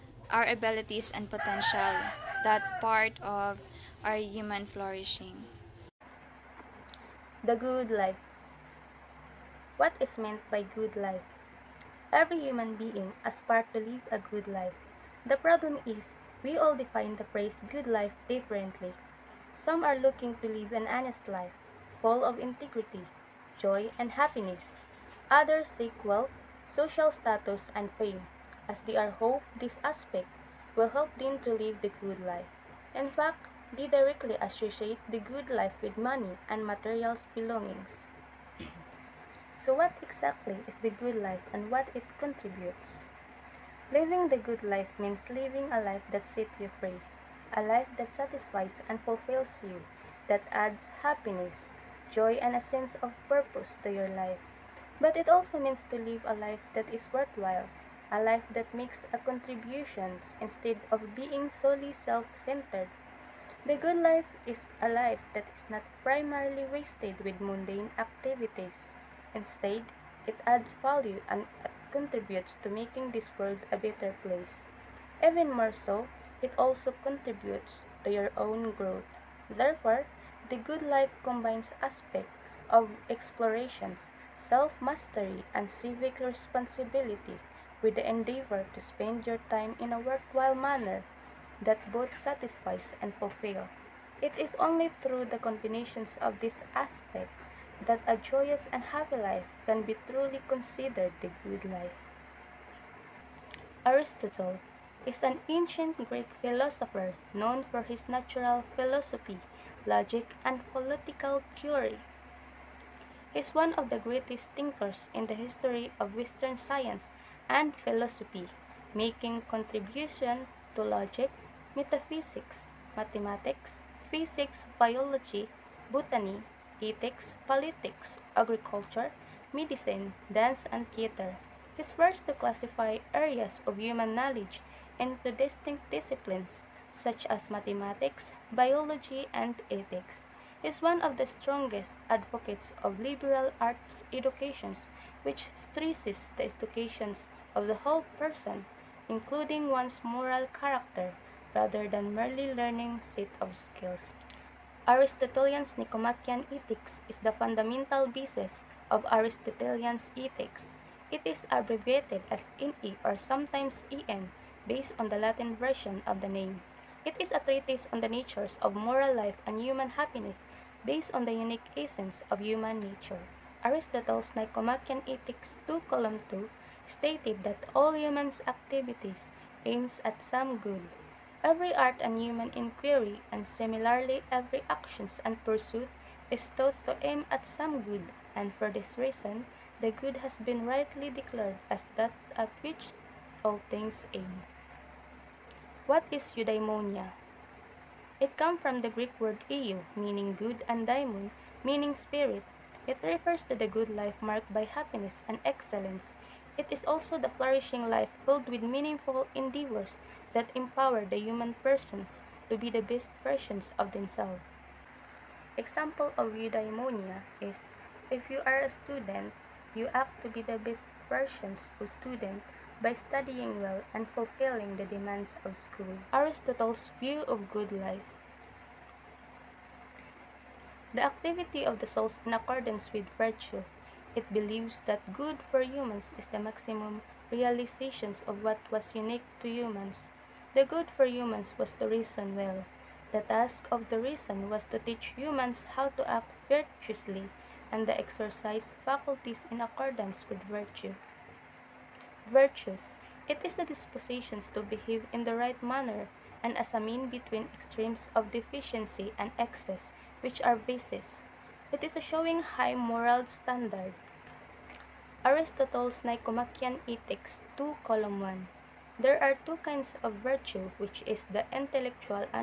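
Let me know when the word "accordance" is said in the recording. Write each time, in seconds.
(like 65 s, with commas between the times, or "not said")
232 s, 249 s.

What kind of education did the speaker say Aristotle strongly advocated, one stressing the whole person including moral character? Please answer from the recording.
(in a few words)
liberal arts.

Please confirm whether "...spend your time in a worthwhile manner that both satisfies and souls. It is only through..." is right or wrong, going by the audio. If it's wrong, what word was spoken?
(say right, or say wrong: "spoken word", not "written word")
wrong: "fulfills", not "souls".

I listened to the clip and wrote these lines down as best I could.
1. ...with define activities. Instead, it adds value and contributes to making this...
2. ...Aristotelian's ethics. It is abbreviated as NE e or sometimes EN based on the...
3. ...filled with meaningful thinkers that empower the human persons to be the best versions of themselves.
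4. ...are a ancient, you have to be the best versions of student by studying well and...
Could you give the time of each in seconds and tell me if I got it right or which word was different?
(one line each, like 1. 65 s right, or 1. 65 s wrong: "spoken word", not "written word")
1. 67 s wrong: "mundane", not "define"
2. 159 s right
3. 208 s wrong: "endeavors", not "thinkers"
4. 218 s wrong: "student", not "ancient".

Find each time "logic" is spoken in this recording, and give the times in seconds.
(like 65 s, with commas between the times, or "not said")
109 s, 120 s.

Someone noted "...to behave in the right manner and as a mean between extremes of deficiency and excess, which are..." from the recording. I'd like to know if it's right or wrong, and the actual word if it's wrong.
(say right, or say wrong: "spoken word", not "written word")
right.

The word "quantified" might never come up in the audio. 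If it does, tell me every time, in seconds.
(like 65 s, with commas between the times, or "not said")
not said.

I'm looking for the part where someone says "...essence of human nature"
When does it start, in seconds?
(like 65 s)
171 s.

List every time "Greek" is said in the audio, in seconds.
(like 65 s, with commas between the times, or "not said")
106 s, 198 s.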